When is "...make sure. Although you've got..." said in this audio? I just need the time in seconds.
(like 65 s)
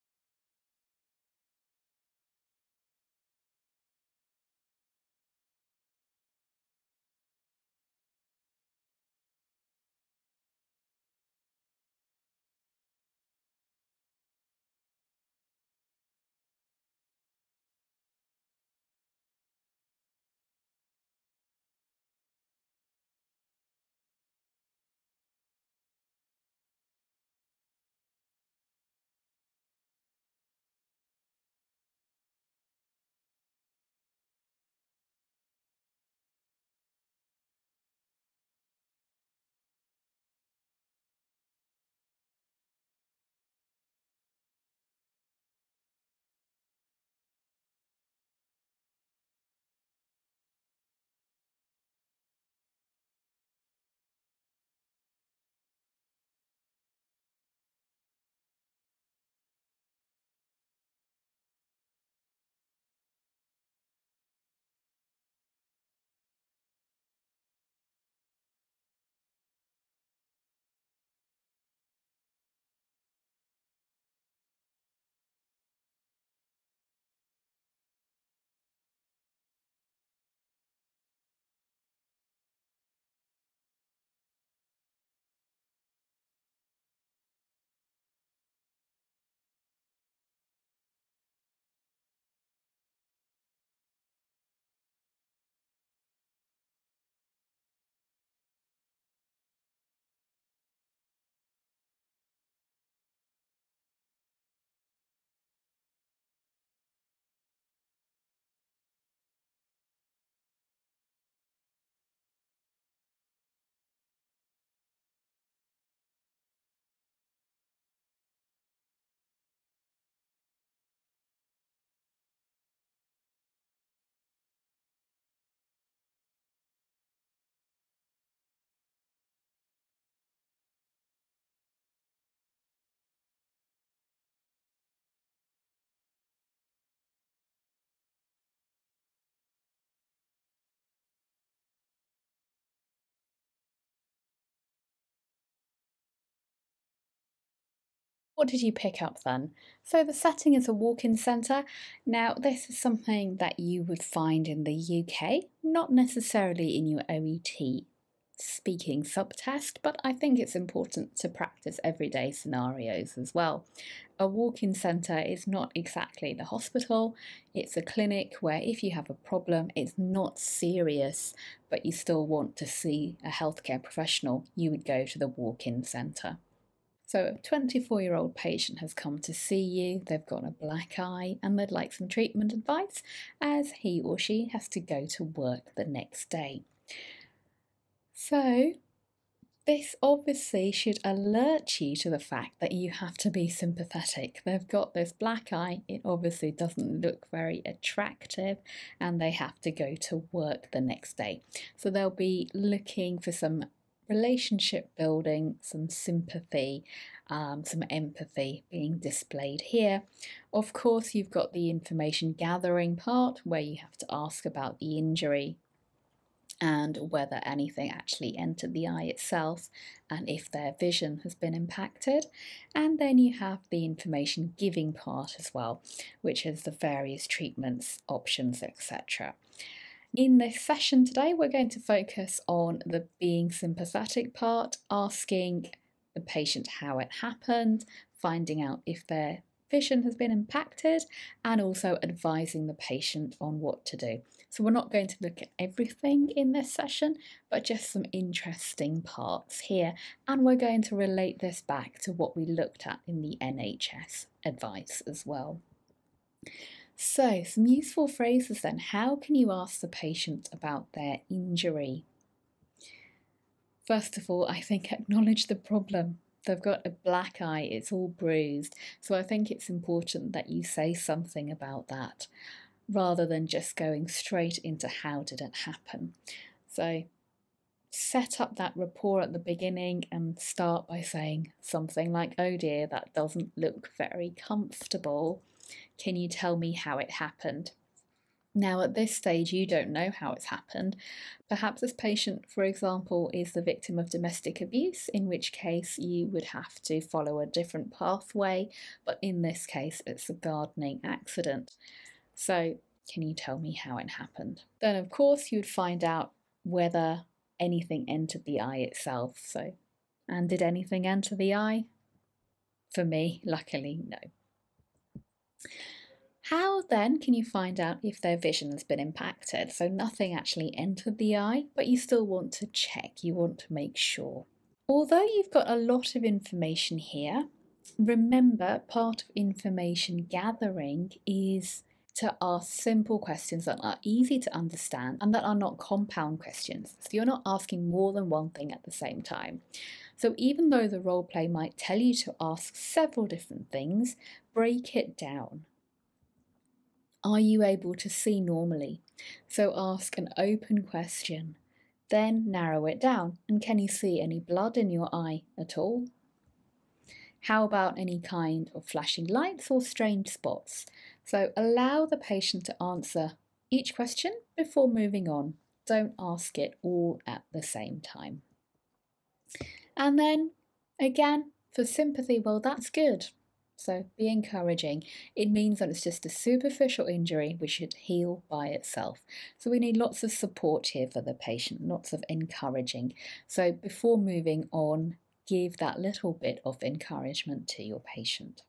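323 s.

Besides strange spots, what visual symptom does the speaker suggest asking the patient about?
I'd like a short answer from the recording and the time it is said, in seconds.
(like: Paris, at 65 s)
Flashing lights, at 358 s.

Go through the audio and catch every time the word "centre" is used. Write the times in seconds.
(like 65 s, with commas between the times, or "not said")
151 s, 164 s, 175 s.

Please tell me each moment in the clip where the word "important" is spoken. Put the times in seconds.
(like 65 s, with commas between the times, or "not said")
160 s, 269 s.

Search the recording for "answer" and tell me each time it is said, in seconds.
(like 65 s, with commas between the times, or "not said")
362 s.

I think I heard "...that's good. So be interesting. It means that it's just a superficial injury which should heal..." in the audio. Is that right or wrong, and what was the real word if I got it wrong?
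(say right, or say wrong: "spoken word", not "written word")
wrong: "encouraging", not "interesting".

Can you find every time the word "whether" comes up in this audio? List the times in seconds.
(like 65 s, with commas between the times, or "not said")
217 s, 306 s.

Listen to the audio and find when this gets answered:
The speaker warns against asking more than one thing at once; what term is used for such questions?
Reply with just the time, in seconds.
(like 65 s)
335 s.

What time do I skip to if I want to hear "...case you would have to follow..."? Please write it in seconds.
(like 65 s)
295 s.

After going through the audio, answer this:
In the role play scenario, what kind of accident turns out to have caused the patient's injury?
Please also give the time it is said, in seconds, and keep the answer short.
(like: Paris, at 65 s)
Gardening accident, at 300 s.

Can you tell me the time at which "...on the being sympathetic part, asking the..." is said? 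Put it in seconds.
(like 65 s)
232 s.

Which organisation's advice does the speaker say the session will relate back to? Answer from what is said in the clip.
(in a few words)
NHS.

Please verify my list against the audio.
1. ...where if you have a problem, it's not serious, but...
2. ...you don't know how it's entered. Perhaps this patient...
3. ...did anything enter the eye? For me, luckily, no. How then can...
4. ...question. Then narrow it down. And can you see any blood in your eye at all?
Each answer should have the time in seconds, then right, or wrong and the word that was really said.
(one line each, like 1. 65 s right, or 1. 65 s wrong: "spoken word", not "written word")
1. 168 s right
2. 289 s wrong: "happened", not "entered"
3. 310 s right
4. 350 s right.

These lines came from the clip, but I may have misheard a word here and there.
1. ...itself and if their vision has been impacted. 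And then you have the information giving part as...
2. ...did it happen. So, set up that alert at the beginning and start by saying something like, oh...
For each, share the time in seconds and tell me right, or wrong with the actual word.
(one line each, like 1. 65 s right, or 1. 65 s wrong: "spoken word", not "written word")
1. 219 s right
2. 275 s wrong: "rapport", not "alert".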